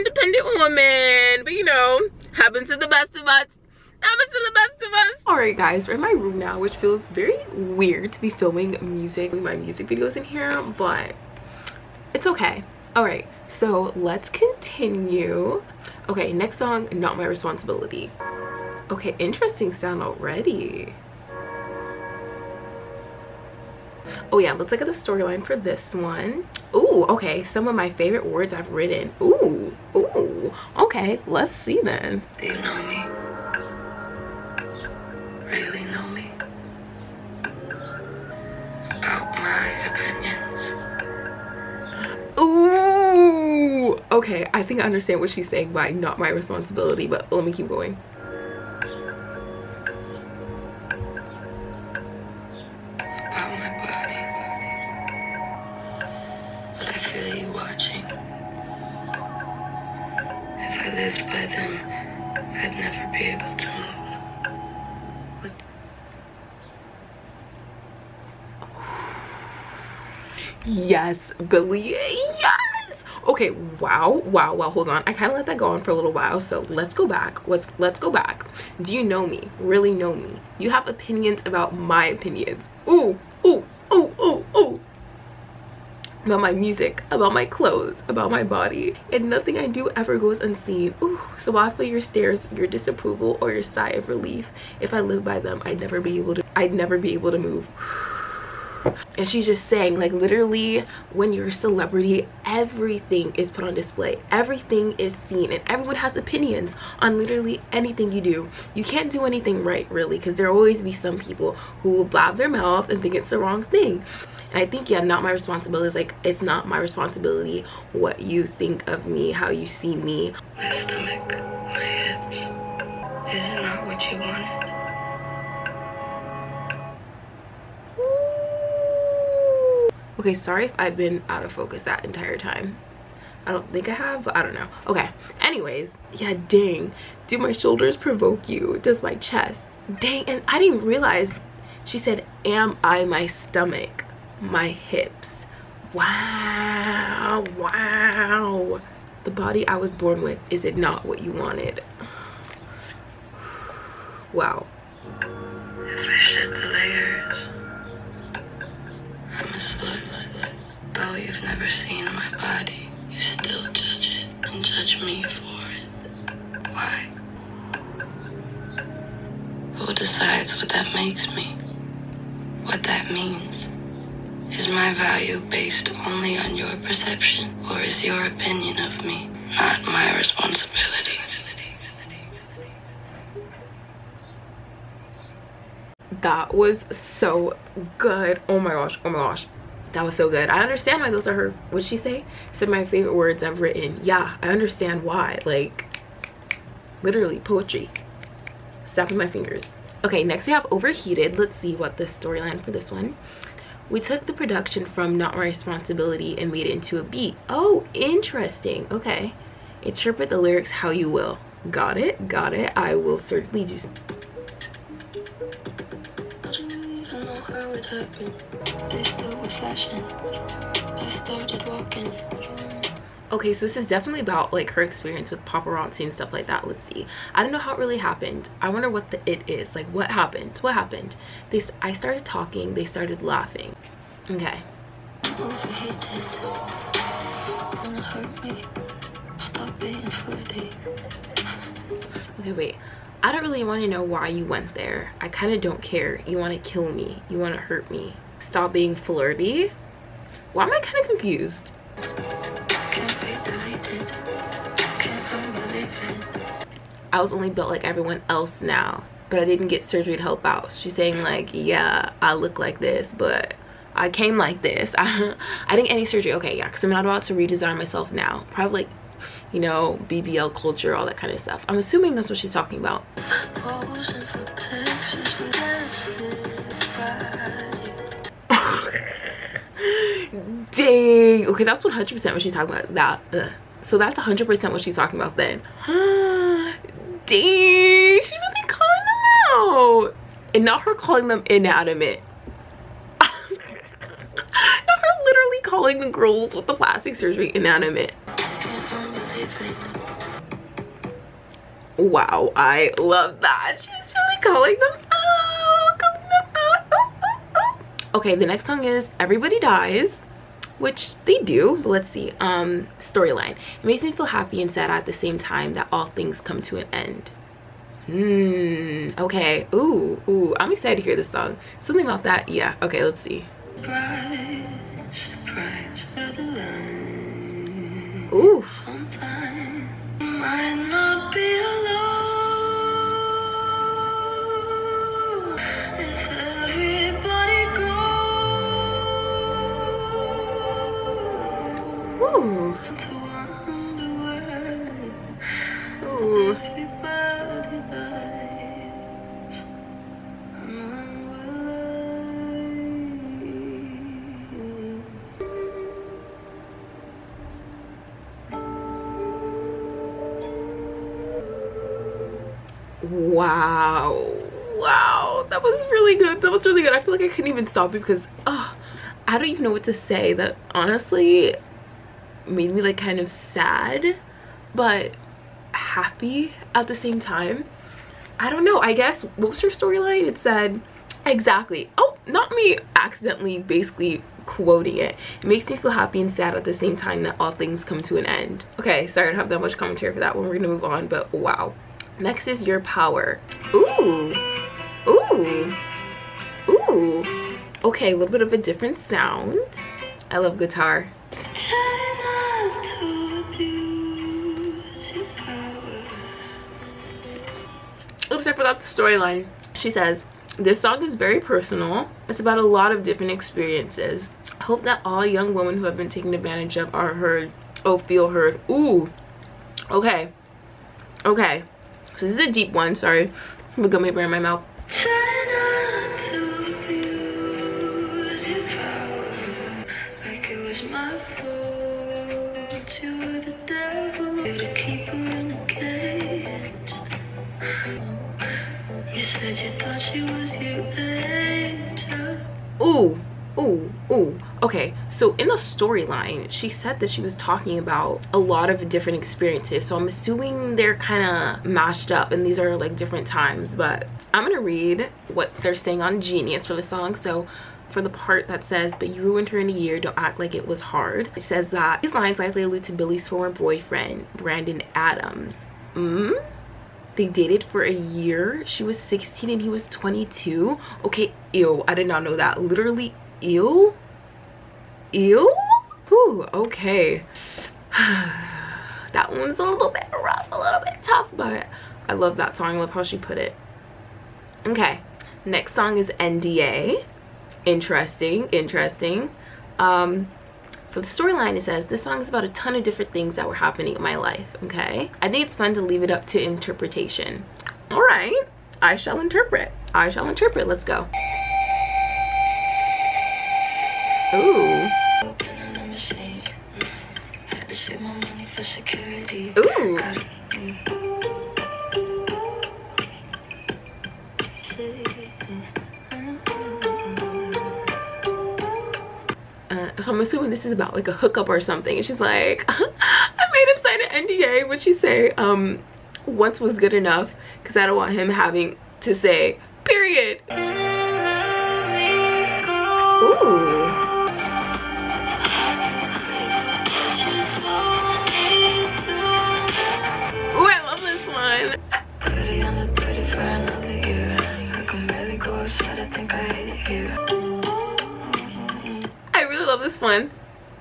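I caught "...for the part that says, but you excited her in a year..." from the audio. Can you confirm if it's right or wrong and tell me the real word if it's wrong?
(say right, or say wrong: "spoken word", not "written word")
wrong: "ruined", not "excited".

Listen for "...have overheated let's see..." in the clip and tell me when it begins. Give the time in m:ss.
3:20.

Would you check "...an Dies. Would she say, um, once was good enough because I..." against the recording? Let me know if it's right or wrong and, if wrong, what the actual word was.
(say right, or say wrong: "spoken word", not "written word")
wrong: "NDA", not "Dies".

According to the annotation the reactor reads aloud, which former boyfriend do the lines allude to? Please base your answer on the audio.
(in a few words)
Brandon Adams.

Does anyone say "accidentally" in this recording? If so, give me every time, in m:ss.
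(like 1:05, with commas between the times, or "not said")
6:22.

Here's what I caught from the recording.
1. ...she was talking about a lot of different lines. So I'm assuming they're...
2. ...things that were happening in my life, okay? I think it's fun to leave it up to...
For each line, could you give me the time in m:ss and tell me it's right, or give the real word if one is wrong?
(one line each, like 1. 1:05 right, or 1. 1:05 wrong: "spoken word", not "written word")
1. 7:27 wrong: "experiences", not "lines"
2. 8:13 right.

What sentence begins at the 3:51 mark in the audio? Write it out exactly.
They I started talking, they started laughing.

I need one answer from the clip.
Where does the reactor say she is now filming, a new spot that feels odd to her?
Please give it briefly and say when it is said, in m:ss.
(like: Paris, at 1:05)
My room, at 0:06.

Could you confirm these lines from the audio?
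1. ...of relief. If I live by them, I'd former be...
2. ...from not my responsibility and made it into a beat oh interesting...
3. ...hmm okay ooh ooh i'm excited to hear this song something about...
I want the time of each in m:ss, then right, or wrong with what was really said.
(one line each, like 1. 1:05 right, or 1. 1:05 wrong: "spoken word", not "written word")
1. 1:33 wrong: "never", not "former"
2. 3:24 right
3. 5:18 right.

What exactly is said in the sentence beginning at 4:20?
She's saying like, yeah, I look like this, but I came like this.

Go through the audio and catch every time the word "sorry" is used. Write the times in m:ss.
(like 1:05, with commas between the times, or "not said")
2:10, 6:29.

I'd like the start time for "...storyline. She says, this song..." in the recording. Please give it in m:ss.
6:48.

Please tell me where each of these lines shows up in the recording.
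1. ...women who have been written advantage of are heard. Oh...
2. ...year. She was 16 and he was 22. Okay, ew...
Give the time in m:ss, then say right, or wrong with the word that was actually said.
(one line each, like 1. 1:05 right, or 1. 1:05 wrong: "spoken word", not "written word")
1. 6:55 wrong: "taken", not "written"
2. 7:47 right.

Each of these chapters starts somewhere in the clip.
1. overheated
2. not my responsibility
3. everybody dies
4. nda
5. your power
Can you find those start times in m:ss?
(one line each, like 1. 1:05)
1. 3:18
2. 0:16
3. 5:11
4. 8:02
5. 6:30.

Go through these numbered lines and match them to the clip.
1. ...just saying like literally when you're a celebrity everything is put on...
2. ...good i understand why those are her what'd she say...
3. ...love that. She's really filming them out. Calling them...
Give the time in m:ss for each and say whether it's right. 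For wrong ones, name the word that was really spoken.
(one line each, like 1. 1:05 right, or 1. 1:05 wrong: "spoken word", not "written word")
1. 1:39 right
2. 3:10 right
3. 5:02 wrong: "calling", not "filming".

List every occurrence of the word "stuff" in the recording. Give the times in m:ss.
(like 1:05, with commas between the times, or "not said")
3:46, 4:31.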